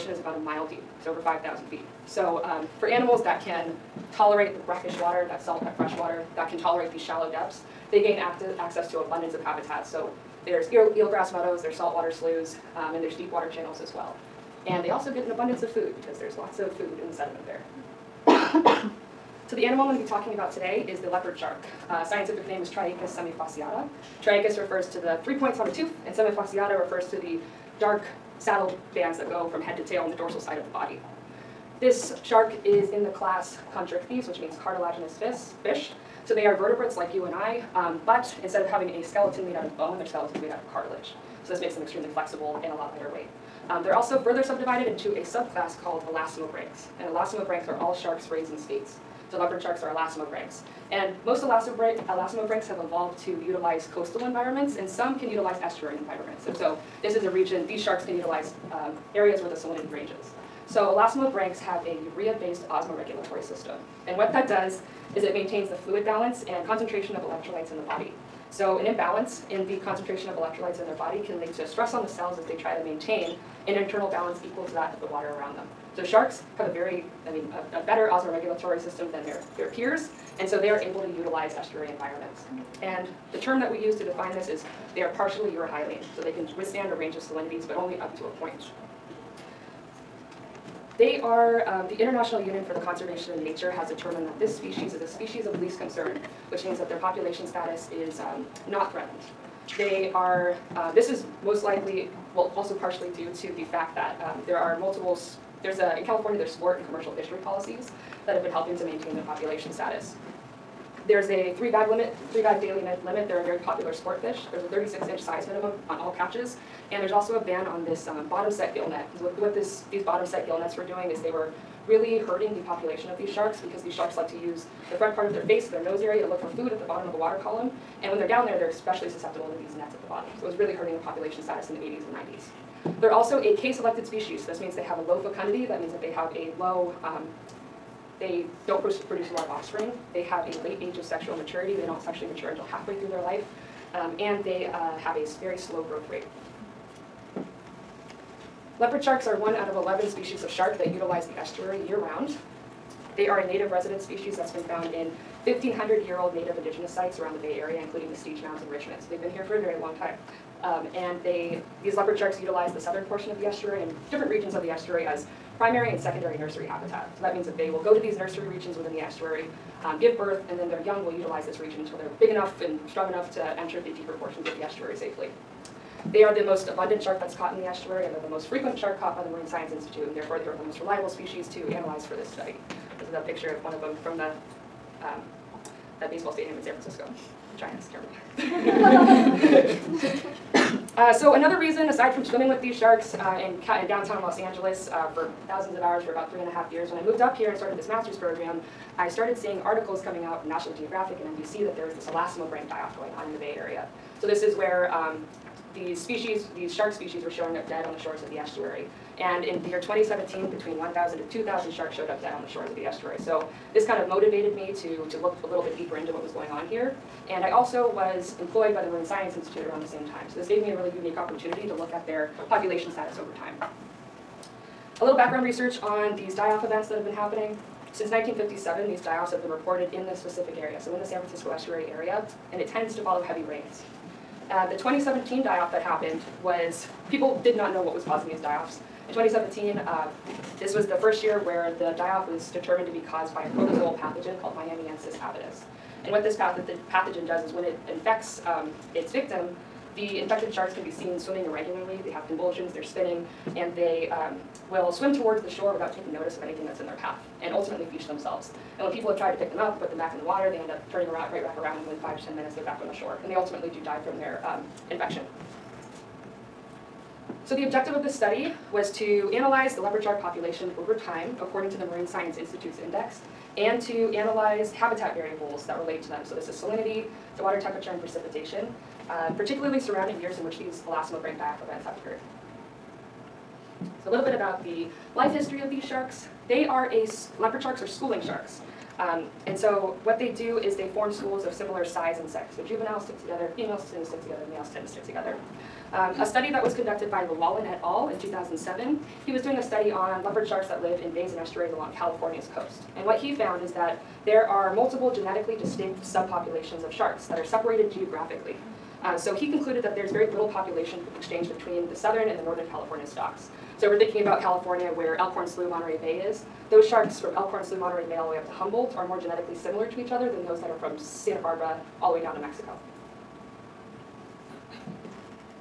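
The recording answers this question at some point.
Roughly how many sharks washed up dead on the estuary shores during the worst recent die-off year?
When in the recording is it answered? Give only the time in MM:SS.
03:30.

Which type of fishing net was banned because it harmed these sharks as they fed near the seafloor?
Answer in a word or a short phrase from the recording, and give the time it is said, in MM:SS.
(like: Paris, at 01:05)
bottom set gill net, at 01:58.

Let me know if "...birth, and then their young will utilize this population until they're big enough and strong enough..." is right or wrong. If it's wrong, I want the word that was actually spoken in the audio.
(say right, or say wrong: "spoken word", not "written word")
wrong: "region", not "population".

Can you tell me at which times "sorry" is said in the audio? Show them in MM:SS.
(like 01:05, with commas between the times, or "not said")
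not said.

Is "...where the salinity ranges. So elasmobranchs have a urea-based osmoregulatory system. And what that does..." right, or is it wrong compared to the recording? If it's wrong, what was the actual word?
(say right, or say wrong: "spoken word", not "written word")
right.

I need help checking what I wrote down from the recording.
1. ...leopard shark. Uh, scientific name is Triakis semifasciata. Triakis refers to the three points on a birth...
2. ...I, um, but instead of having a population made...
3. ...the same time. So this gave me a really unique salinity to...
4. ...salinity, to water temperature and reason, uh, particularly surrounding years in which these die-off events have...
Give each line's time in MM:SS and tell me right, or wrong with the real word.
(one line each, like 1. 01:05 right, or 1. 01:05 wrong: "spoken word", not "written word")
1. 00:21 wrong: "tooth", not "birth"
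2. 00:37 wrong: "skeleton", not "population"
3. 03:39 wrong: "opportunity", not "salinity"
4. 04:36 wrong: "precipitation", not "reason".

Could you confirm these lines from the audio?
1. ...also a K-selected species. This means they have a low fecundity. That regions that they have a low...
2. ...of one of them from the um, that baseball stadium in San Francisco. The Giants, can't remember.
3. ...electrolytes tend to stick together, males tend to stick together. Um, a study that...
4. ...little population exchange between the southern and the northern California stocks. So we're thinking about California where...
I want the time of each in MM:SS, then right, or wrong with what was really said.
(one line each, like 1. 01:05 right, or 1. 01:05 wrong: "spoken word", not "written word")
1. 02:13 wrong: "means", not "regions"
2. 03:03 right
3. 04:53 wrong: "females", not "electrolytes"
4. 05:10 right.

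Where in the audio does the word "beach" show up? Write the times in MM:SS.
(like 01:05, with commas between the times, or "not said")
04:17.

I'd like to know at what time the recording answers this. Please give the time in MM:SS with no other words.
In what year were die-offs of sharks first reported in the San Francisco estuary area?
03:48.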